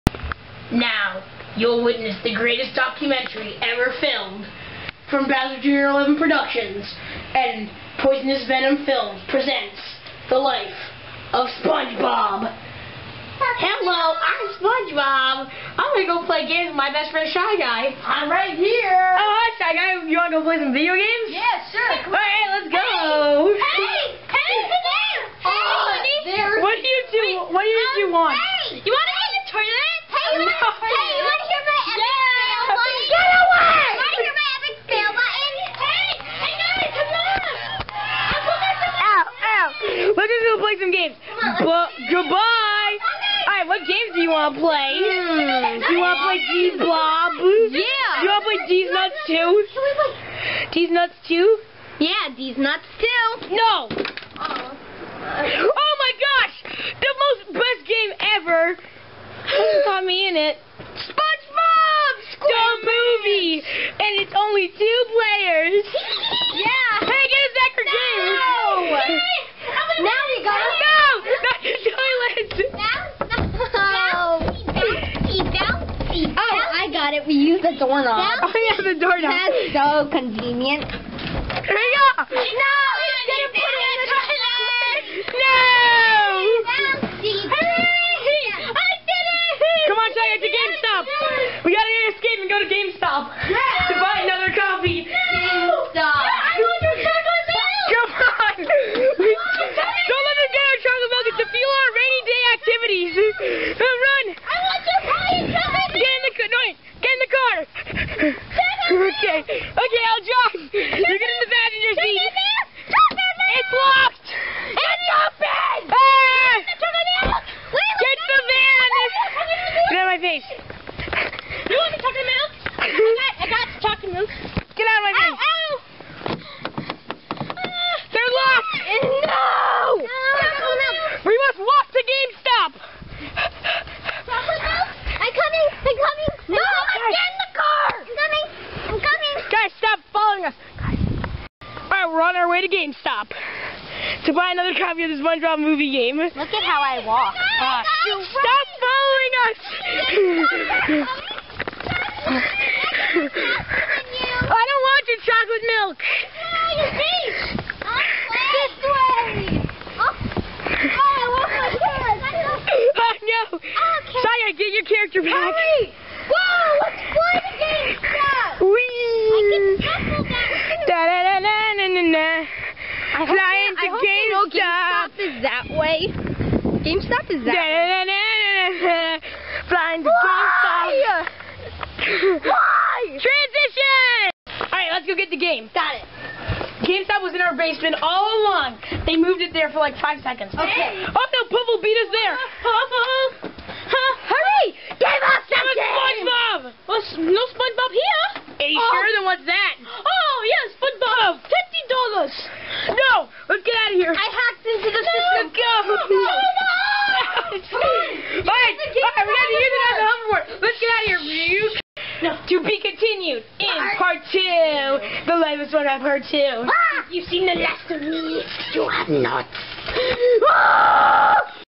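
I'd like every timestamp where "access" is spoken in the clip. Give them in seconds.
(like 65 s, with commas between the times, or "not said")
not said.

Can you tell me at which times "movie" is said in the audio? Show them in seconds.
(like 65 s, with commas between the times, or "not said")
62 s, 145 s.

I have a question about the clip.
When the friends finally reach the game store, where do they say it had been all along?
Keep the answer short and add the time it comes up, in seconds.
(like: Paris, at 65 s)
Our basement, at 187 s.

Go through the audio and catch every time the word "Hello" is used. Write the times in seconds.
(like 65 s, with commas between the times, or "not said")
12 s.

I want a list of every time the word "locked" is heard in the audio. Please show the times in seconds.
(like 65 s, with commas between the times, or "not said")
128 s.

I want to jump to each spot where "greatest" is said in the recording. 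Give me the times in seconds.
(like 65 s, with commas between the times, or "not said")
2 s.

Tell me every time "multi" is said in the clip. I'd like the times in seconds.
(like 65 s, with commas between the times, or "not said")
not said.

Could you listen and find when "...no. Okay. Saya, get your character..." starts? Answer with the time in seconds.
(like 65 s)
163 s.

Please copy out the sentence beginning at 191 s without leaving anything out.
Oh no, Pubble beat us there.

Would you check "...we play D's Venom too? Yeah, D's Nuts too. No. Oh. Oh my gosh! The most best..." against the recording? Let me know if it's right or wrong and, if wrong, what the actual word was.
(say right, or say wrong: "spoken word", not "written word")
wrong: "Nuts", not "Venom".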